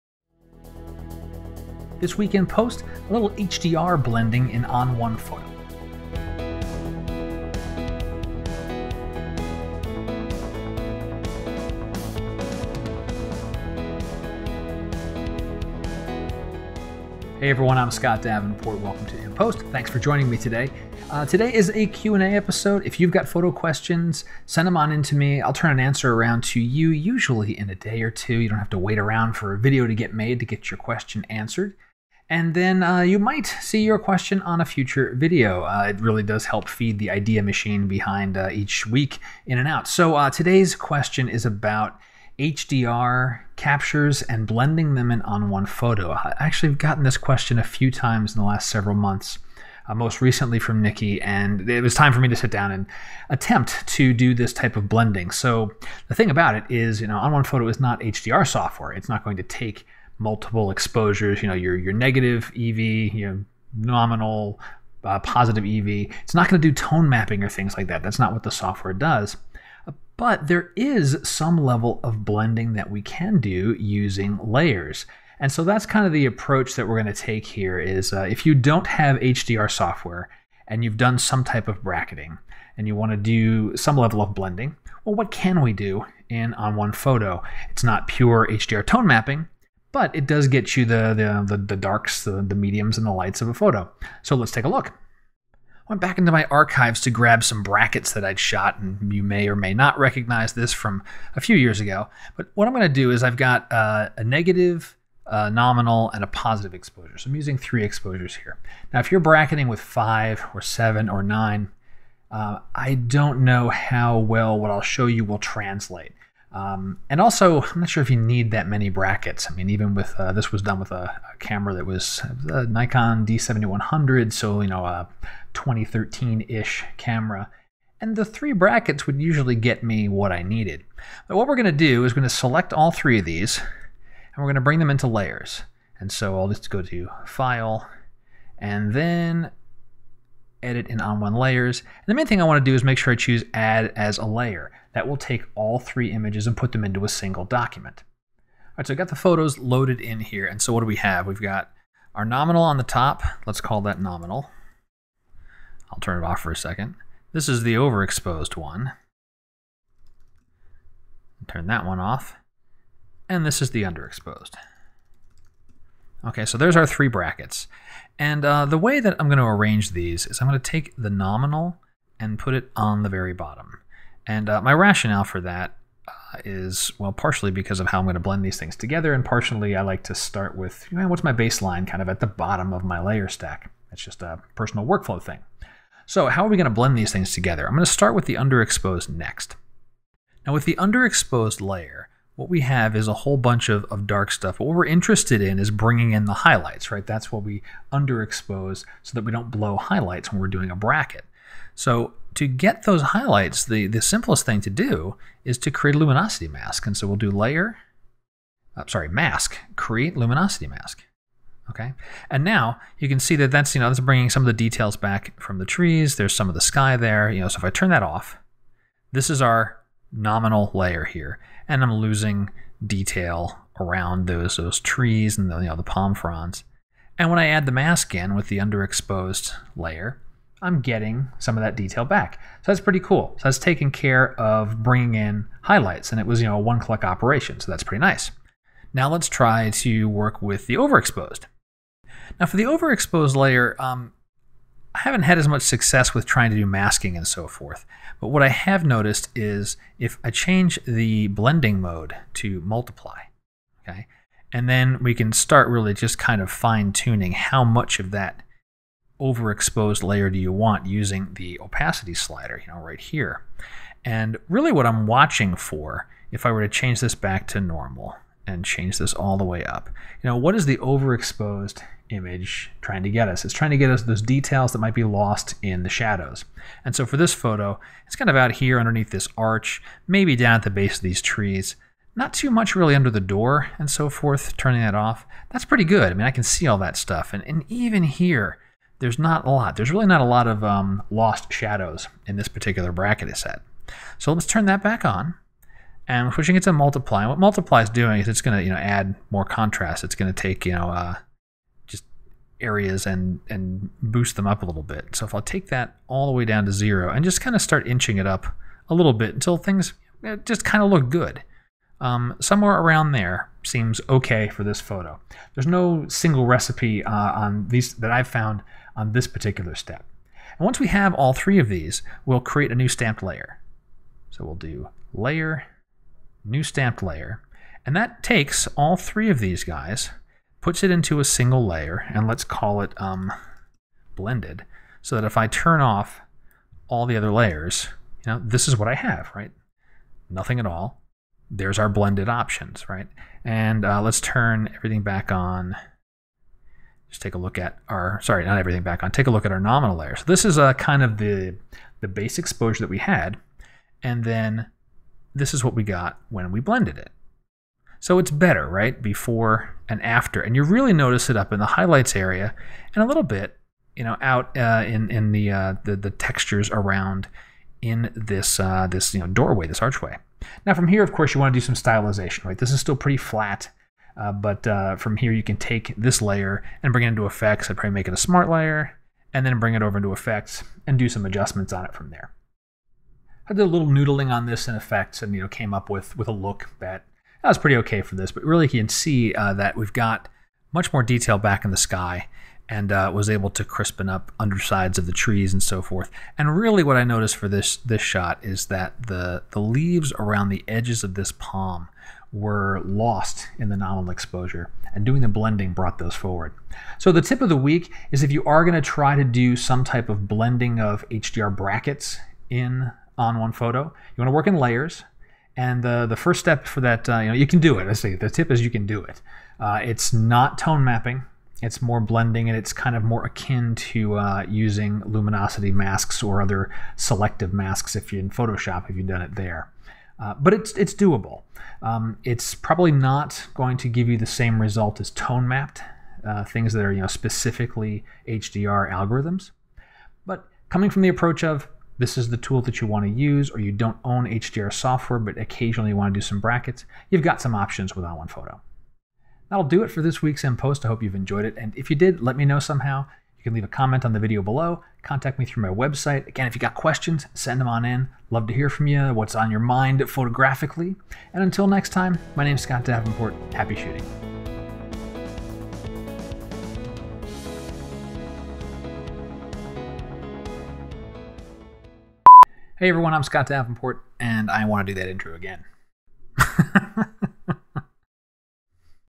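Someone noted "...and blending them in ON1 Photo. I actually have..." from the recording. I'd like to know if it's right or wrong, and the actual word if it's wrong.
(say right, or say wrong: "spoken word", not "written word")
right.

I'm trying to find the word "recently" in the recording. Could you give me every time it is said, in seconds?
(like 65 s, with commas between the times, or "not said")
50 s.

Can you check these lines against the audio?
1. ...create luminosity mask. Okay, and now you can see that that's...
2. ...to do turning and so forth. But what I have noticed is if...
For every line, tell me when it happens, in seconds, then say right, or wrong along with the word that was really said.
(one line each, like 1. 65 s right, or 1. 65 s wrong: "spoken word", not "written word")
1. 209 s right
2. 246 s wrong: "masking", not "turning".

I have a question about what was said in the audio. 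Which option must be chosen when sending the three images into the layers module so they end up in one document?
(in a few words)
add as a layer.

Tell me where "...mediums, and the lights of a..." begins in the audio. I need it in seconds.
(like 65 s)
92 s.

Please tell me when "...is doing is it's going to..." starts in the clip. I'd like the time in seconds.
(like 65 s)
297 s.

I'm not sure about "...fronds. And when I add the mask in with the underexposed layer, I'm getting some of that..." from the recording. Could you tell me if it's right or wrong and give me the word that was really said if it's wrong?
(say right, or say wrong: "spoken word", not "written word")
right.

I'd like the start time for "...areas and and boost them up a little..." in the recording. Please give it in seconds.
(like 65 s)
302 s.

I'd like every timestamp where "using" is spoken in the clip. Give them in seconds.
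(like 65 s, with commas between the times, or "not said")
73 s, 107 s, 260 s, 424 s.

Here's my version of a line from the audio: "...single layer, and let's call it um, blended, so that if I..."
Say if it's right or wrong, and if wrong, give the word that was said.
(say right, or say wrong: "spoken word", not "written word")
right.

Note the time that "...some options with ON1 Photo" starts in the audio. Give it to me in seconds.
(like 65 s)
447 s.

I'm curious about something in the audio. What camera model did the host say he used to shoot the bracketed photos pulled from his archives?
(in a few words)
Nikon D7100.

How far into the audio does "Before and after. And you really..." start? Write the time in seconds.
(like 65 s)
359 s.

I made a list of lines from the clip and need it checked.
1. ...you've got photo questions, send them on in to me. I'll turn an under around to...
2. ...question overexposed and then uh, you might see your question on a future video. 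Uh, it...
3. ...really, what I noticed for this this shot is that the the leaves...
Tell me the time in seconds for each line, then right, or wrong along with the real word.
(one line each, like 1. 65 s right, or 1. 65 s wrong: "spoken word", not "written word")
1. 22 s wrong: "answer", not "under"
2. 30 s wrong: "answered", not "overexposed"
3. 396 s right.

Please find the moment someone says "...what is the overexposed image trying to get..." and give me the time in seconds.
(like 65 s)
270 s.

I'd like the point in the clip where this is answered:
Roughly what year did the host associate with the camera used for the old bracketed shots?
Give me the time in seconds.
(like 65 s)
125 s.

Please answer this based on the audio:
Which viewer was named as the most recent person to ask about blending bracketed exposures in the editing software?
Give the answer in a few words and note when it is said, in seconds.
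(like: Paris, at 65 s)
Nikki, at 50 s.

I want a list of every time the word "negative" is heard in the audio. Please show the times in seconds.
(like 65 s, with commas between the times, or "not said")
61 s, 104 s.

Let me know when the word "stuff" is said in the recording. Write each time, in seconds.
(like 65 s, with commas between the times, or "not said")
194 s, 286 s.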